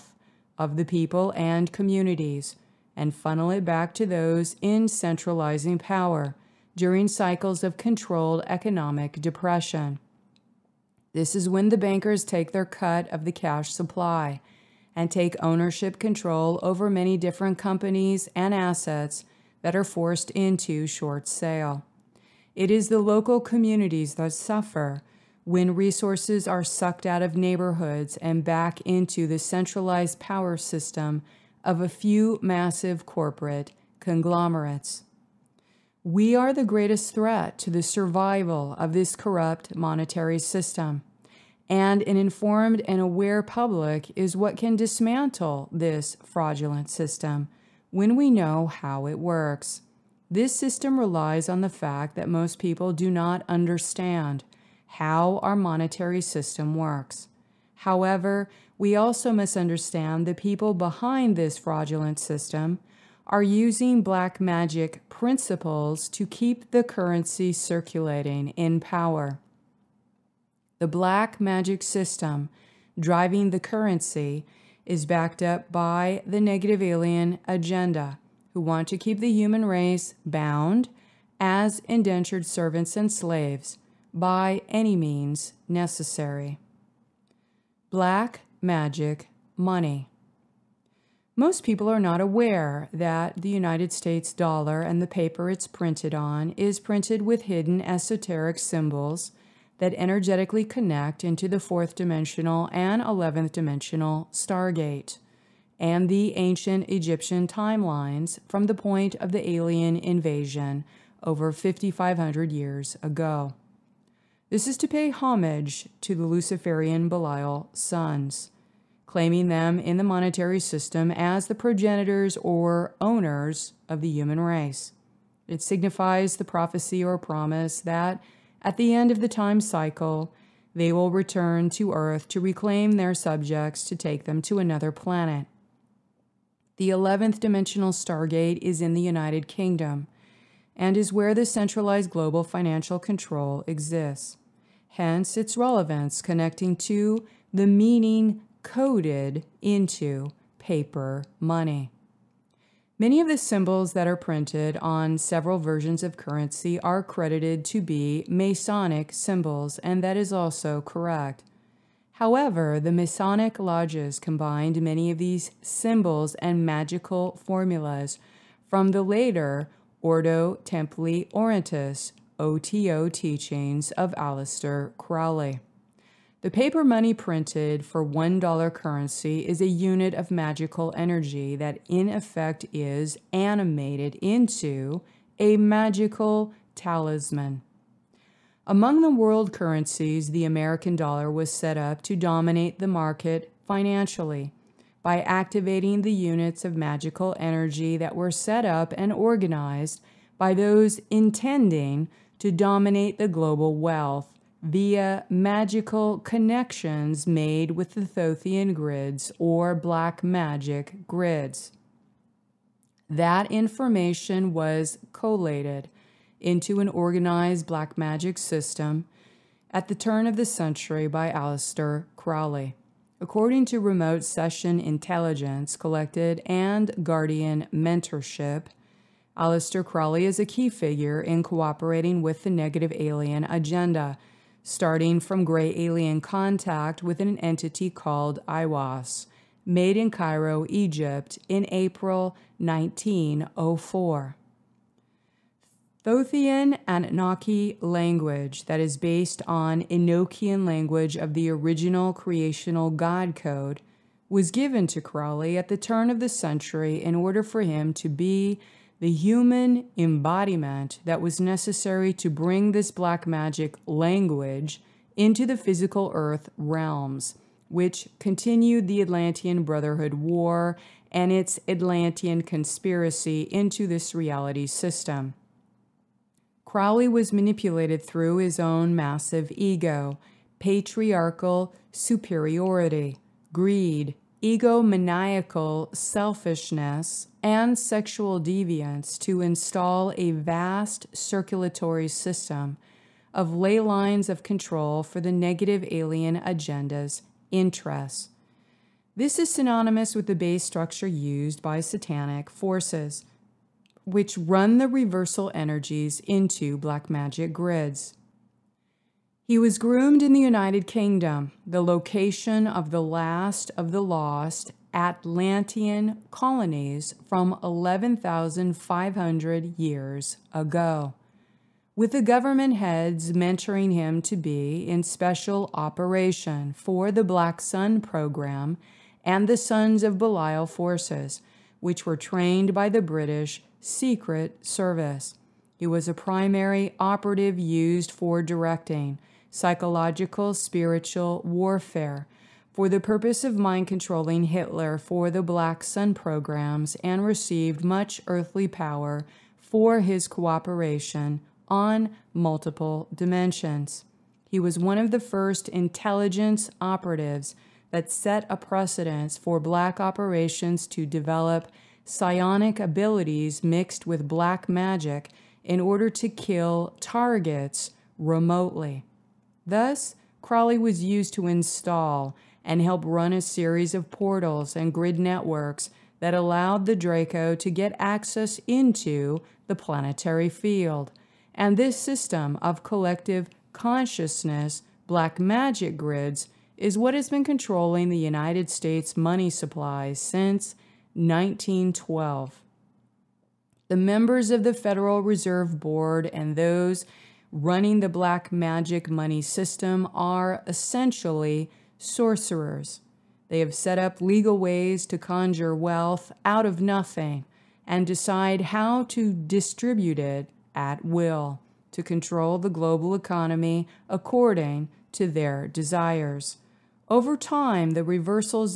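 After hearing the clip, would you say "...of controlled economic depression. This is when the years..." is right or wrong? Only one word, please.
wrong.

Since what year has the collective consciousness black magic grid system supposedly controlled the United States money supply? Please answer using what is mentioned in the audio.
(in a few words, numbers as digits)
1912.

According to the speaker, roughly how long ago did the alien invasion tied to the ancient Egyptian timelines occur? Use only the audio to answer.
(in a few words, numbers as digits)
5,500 years ago.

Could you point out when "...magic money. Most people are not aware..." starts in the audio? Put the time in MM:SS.
01:28.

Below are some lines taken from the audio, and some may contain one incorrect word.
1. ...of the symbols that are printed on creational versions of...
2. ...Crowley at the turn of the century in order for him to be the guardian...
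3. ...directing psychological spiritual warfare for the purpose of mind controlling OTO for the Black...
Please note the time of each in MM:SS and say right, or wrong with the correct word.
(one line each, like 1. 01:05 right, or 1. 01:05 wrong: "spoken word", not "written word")
1. 02:33 wrong: "several", not "creational"
2. 04:15 wrong: "human", not "guardian"
3. 05:38 wrong: "Hitler", not "OTO".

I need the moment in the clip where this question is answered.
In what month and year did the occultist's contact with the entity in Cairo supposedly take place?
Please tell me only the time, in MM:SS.
04:01.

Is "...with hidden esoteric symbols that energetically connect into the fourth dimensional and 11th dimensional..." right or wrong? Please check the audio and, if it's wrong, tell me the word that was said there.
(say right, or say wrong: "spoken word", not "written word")
right.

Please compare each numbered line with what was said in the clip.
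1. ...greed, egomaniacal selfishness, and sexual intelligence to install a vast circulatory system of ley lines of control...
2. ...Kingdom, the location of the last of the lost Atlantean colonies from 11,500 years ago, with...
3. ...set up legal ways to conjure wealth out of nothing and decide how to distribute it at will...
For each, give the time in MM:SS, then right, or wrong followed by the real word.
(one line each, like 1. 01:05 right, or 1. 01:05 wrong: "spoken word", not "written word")
1. 04:43 wrong: "deviance", not "intelligence"
2. 05:10 right
3. 06:43 right.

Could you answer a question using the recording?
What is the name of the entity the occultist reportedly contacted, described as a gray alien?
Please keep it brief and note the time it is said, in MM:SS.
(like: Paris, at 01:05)
Aiwass, at 03:58.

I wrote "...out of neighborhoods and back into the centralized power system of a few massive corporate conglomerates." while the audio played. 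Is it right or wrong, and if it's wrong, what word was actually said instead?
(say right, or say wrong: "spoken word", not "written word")
right.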